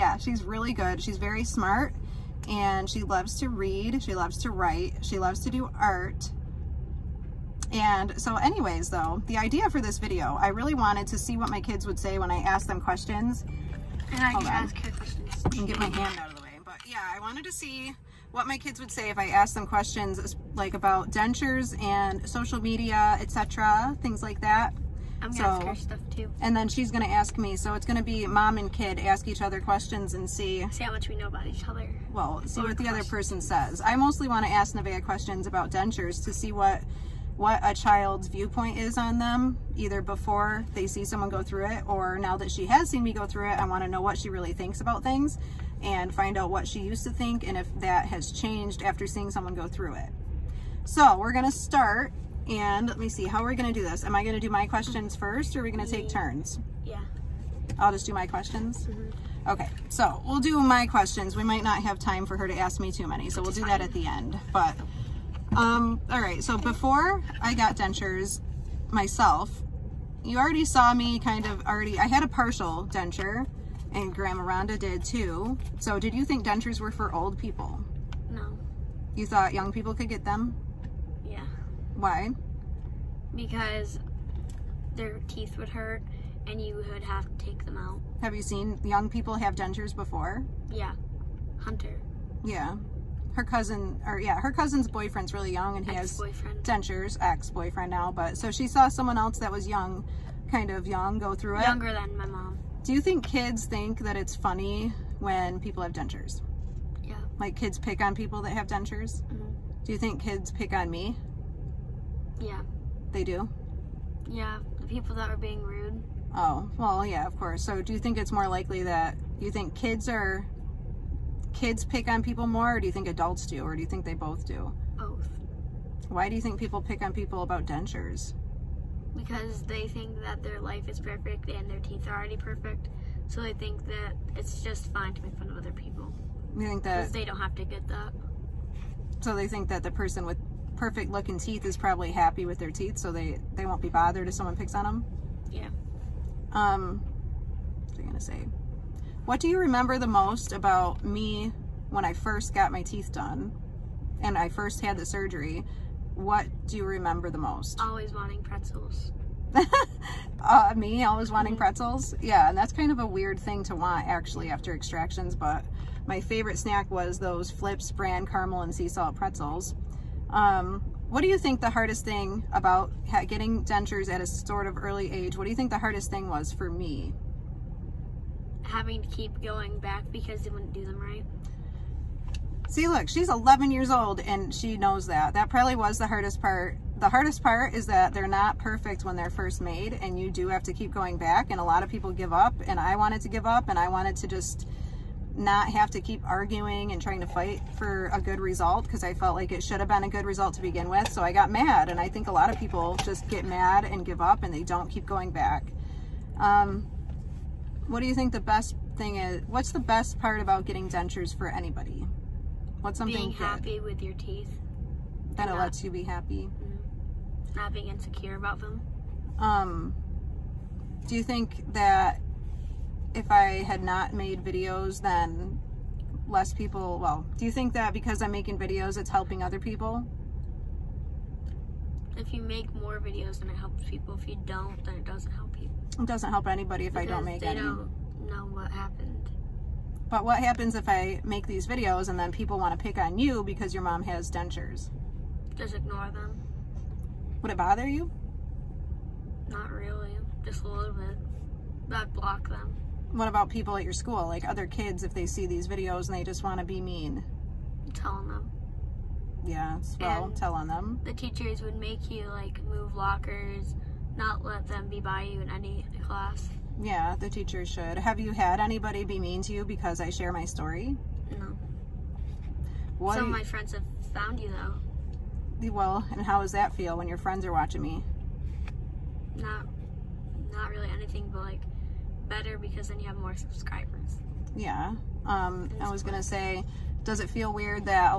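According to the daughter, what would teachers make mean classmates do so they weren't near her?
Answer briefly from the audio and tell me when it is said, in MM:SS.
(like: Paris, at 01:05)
move lockers, at 04:22.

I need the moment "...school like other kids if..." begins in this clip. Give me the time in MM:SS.
04:13.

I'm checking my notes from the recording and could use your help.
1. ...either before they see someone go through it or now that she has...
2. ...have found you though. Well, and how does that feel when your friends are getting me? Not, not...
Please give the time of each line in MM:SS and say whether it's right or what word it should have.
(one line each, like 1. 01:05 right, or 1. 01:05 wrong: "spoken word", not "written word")
1. 00:39 right
2. 04:33 wrong: "watching", not "getting".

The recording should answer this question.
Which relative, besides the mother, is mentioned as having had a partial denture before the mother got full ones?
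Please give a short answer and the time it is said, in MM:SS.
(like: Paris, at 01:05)
Grandma Rhonda, at 01:14.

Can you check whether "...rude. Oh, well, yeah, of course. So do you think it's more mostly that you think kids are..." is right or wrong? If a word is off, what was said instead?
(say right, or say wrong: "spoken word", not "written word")
wrong: "likely", not "mostly".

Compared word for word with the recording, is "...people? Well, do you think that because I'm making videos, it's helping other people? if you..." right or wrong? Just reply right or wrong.
right.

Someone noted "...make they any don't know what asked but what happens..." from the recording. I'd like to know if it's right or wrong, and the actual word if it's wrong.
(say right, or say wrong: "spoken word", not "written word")
wrong: "happened", not "asked".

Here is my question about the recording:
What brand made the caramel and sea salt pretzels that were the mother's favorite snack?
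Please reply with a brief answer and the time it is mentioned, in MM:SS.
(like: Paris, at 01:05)
Flipz, at 02:47.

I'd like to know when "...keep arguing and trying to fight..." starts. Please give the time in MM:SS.
03:16.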